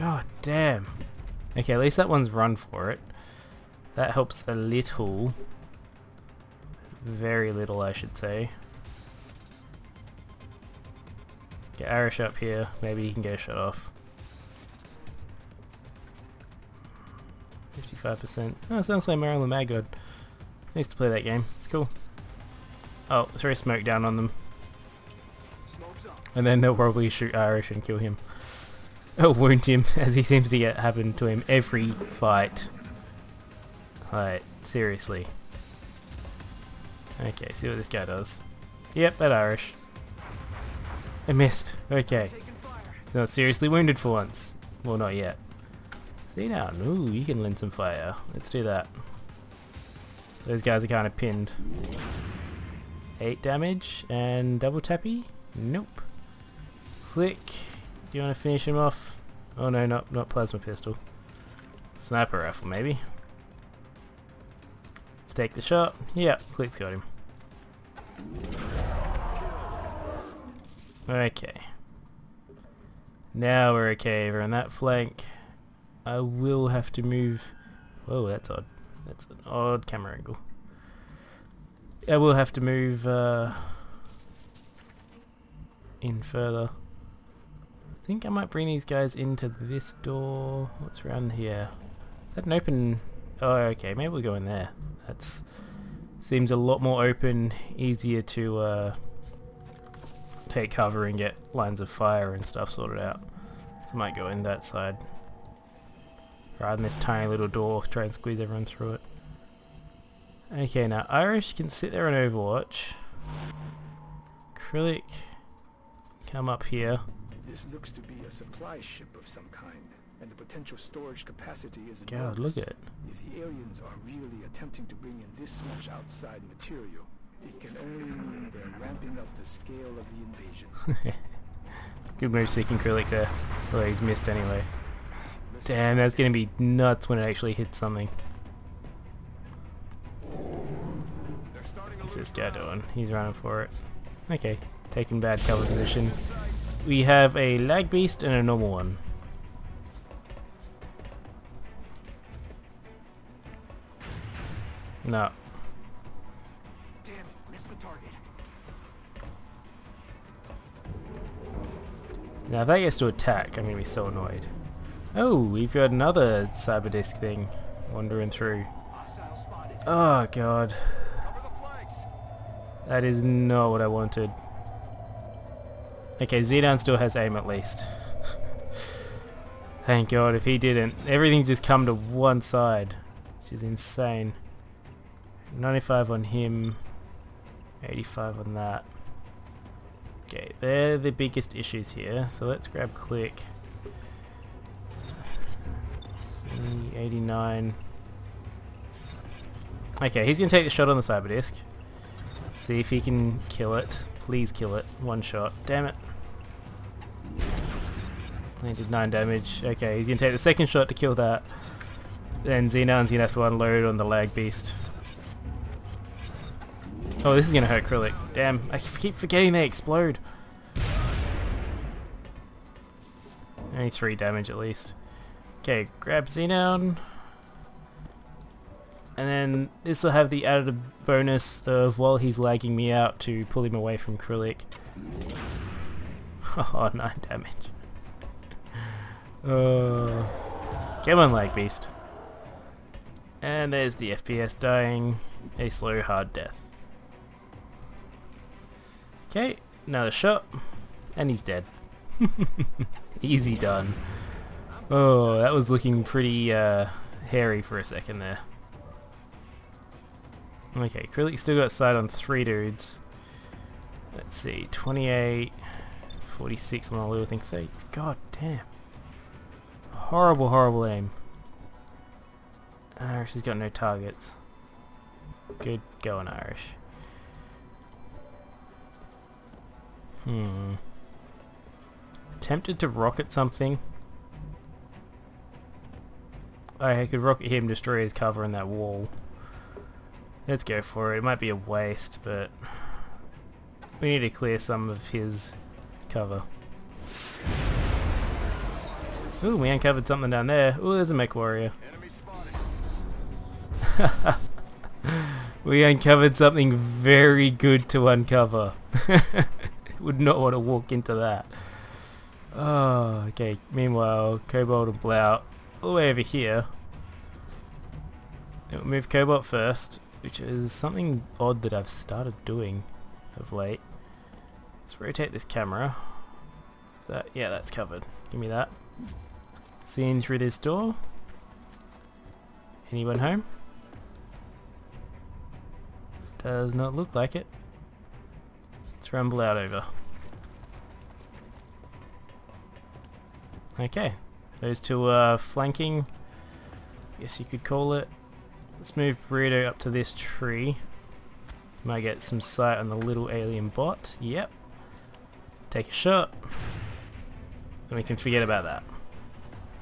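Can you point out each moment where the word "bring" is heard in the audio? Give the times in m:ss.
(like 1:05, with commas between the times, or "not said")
1:28, 2:04.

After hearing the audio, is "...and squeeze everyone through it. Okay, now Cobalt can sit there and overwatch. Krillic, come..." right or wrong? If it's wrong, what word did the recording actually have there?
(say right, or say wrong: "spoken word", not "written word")
wrong: "Irish", not "Cobalt".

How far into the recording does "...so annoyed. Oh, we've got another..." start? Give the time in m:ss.
2:43.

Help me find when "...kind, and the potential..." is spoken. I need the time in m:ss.
1:59.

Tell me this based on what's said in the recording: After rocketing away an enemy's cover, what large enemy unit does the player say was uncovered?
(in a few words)
A mech warrior.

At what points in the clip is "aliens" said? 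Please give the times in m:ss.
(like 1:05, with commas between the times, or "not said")
2:03, 5:53.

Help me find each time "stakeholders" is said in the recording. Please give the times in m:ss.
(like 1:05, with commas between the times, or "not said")
not said.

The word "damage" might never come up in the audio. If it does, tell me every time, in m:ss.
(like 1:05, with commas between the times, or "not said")
0:53, 3:29, 3:44, 3:57.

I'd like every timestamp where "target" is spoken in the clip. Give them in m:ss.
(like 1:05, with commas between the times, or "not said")
2:37, 4:33.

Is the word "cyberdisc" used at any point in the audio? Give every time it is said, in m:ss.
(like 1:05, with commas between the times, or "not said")
2:46, 3:21.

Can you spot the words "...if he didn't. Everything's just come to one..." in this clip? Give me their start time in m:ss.
3:00.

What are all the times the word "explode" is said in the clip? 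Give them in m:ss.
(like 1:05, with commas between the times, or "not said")
3:39.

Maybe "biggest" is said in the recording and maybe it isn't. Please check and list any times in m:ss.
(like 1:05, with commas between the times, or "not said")
3:11.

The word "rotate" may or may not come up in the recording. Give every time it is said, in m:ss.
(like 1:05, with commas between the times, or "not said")
5:25.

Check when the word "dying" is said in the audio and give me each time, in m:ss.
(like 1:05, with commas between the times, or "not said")
4:04.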